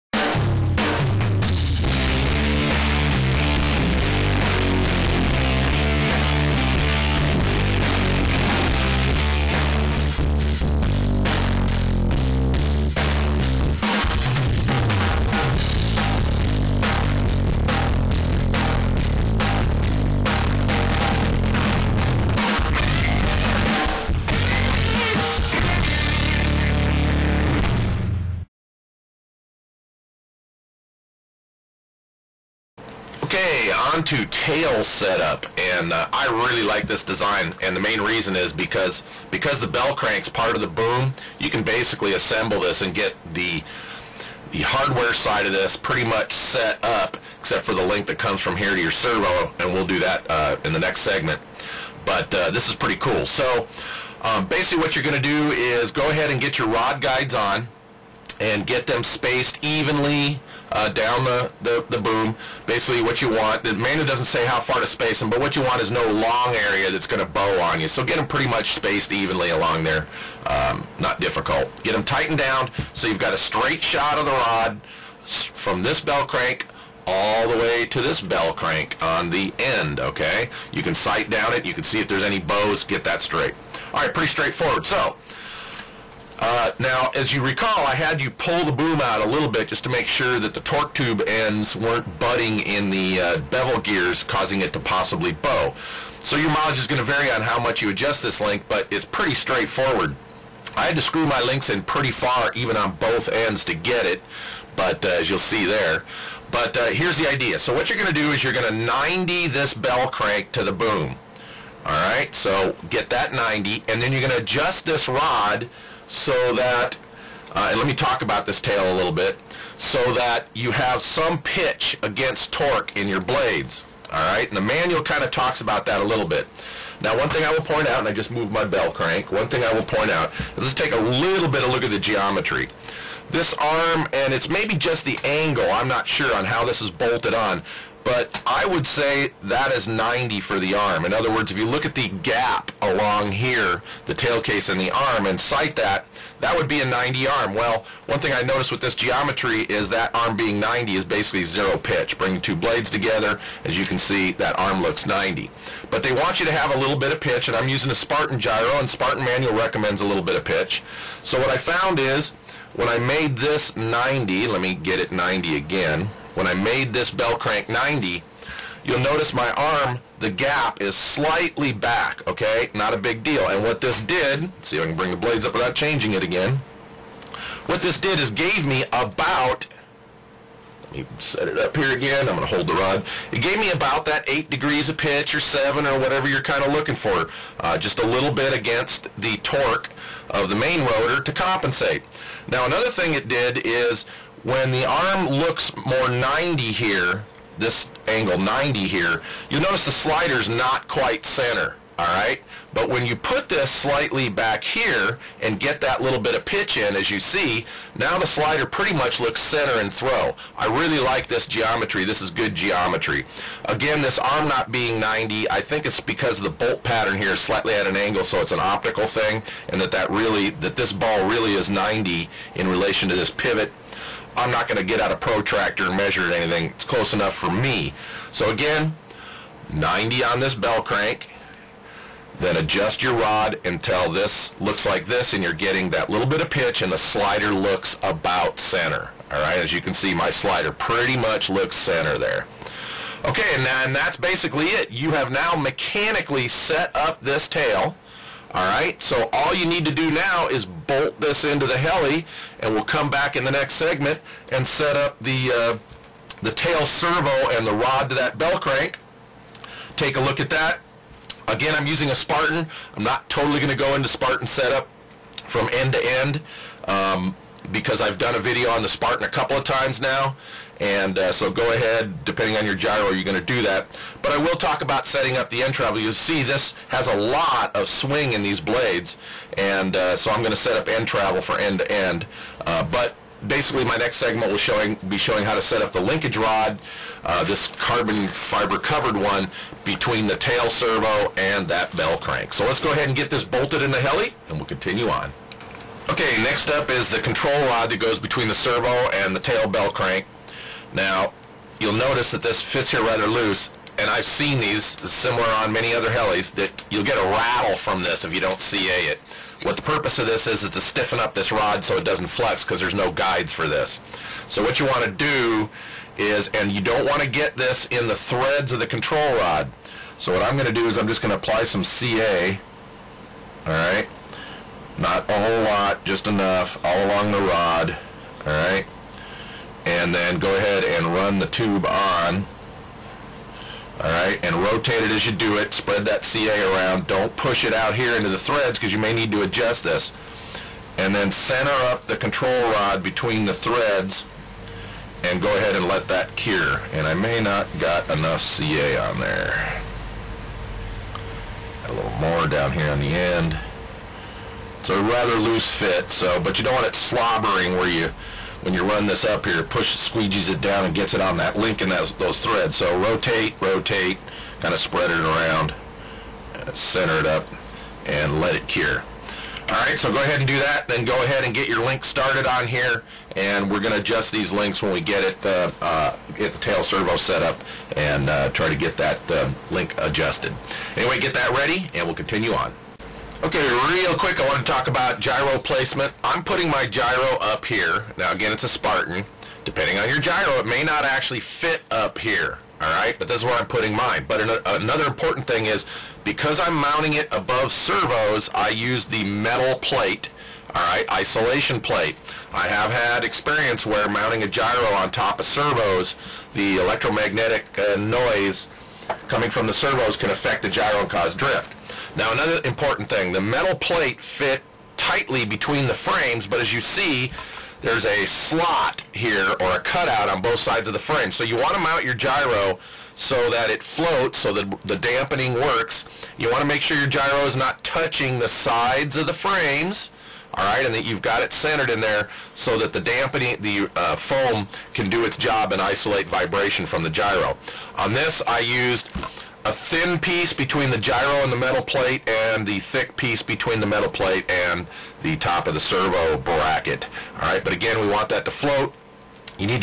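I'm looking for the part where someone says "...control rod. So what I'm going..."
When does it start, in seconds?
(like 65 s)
318 s.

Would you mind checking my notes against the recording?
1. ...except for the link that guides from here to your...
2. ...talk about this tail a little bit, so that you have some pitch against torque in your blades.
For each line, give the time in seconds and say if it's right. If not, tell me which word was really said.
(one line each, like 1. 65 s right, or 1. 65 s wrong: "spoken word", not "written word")
1. 47 s wrong: "comes", not "guides"
2. 117 s right.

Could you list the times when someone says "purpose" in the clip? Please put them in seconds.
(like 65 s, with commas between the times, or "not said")
309 s.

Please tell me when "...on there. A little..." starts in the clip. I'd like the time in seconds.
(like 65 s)
348 s.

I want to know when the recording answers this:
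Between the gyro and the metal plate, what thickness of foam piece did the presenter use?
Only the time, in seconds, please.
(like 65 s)
439 s.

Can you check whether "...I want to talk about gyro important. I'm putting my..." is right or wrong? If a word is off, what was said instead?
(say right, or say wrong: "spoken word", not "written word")
wrong: "placement", not "important".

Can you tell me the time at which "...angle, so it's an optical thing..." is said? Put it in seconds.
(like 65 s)
217 s.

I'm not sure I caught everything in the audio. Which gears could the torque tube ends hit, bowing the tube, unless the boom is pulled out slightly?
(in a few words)
bevel gears.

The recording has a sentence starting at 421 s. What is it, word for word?
So you want to mount your gyro so that it floats, so that the dampening works.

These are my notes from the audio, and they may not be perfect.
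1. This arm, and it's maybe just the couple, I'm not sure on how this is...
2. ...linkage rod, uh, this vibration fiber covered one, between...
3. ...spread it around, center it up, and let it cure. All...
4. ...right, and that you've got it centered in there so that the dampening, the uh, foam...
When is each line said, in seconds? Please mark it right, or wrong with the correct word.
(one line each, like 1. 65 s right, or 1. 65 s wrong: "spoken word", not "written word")
1. 133 s wrong: "angle", not "couple"
2. 285 s wrong: "carbon", not "vibration"
3. 364 s right
4. 430 s right.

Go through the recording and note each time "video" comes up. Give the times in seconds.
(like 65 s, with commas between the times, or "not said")
268 s.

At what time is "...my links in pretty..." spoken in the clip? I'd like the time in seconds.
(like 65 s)
101 s.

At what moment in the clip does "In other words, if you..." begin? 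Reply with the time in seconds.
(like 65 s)
141 s.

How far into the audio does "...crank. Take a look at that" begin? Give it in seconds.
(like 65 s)
258 s.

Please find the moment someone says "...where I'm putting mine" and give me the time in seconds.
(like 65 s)
393 s.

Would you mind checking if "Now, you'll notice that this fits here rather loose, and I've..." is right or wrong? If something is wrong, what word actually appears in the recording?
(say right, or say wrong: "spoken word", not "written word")
right.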